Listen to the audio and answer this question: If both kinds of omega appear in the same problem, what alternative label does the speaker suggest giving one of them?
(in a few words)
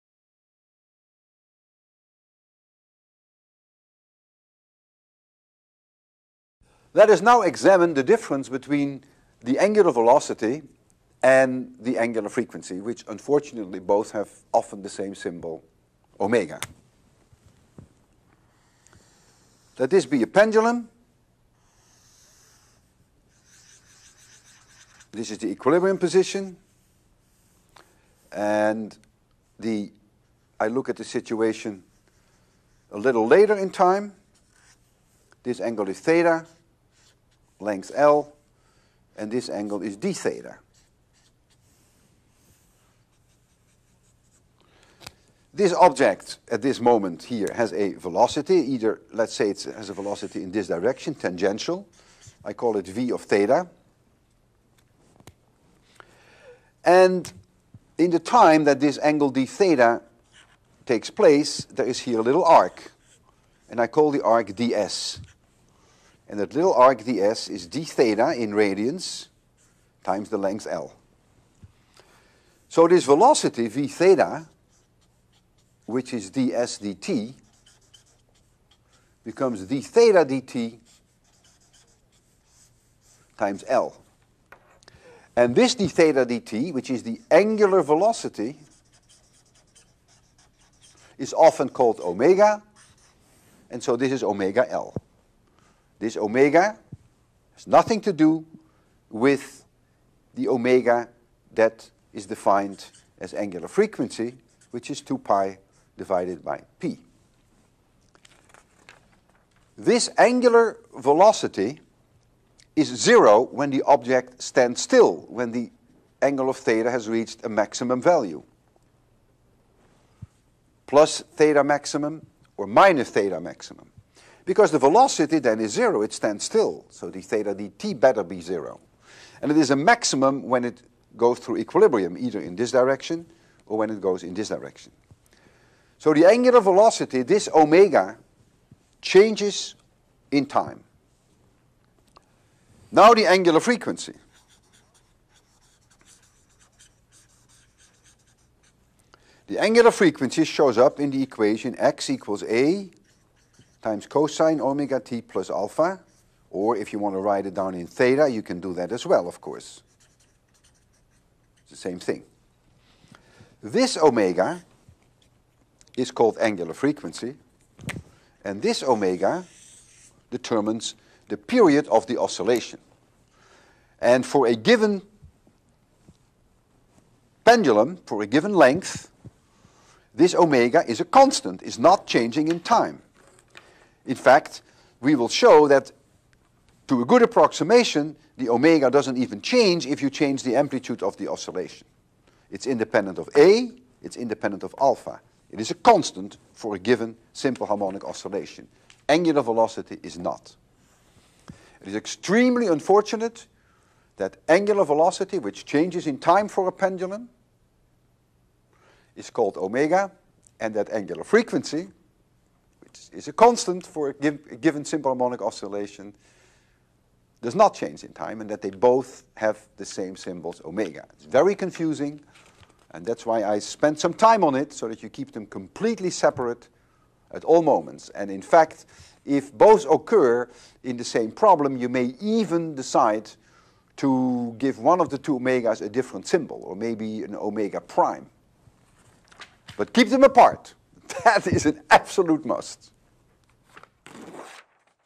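omega prime.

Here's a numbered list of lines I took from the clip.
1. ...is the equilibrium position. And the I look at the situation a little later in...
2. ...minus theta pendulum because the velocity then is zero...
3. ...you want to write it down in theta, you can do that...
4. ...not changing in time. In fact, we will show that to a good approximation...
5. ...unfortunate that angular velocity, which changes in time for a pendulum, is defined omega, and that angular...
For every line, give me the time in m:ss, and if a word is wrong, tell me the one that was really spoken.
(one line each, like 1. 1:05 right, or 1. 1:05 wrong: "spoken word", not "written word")
1. 0:25 right
2. 2:02 wrong: "maximum", not "pendulum"
3. 2:36 right
4. 3:01 right
5. 3:22 wrong: "called", not "defined".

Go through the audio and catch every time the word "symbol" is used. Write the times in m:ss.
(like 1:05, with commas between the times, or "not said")
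0:15, 3:40, 3:56.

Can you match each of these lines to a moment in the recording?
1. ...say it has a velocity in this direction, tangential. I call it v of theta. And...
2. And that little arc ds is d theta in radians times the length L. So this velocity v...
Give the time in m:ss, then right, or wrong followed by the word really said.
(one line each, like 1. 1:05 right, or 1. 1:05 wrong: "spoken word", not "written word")
1. 0:49 right
2. 1:06 right.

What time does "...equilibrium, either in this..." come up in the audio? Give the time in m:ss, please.
2:11.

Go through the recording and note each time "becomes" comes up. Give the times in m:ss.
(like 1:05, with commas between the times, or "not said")
1:19.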